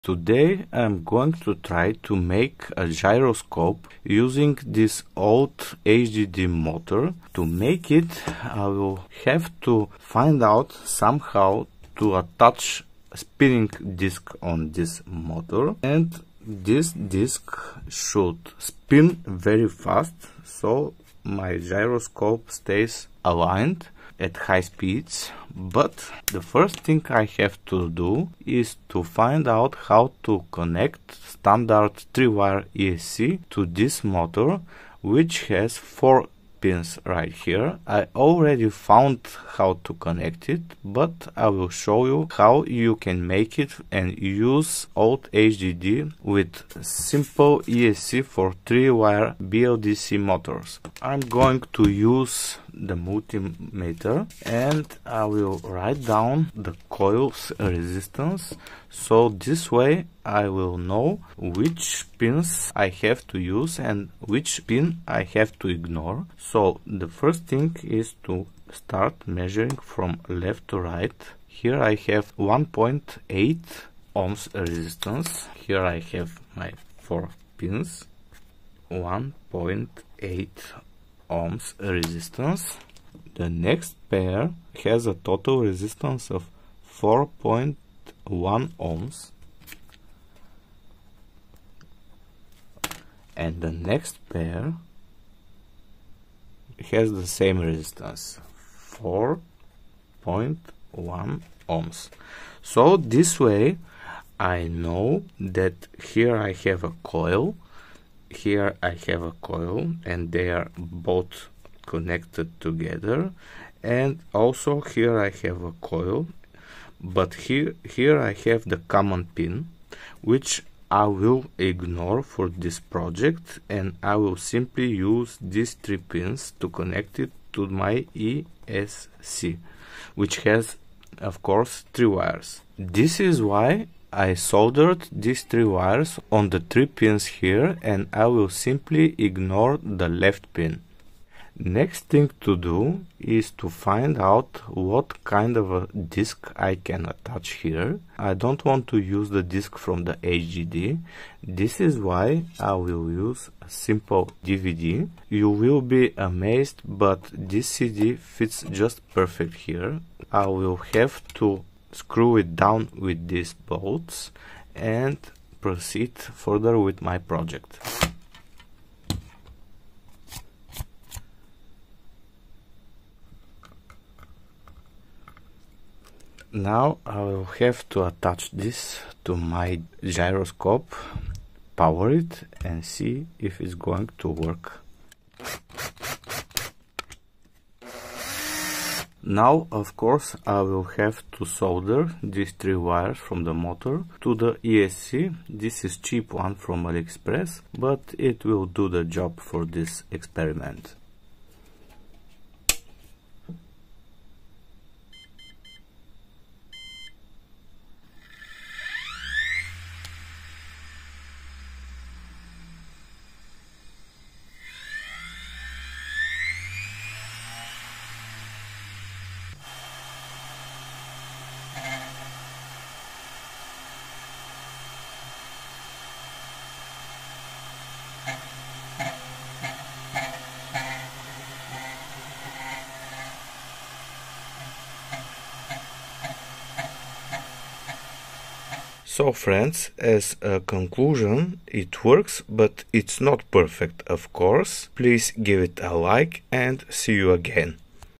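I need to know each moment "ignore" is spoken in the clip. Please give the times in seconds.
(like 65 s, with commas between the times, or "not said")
65 s, 121 s, 139 s.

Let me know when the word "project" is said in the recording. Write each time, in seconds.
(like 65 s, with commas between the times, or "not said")
122 s, 167 s.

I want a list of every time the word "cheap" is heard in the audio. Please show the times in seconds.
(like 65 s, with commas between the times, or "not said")
195 s.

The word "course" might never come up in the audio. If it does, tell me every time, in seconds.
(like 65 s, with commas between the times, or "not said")
131 s, 189 s, 244 s.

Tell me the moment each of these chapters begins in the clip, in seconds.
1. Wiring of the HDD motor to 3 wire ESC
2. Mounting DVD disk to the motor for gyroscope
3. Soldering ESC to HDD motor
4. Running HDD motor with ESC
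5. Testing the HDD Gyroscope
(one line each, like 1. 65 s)
1. 14 s
2. 158 s
3. 190 s
4. 207 s
5. 219 s.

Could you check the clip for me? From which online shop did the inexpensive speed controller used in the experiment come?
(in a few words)
AliExpress.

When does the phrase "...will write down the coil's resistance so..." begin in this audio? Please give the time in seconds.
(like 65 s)
55 s.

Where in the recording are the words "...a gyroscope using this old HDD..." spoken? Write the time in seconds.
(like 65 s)
2 s.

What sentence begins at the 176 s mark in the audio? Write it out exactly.
Now I will have to attach this to my gyroscope, power it and see if it's going to work.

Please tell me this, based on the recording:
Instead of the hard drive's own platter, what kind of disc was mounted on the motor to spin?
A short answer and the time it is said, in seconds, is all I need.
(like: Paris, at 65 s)
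DVD, at 154 s.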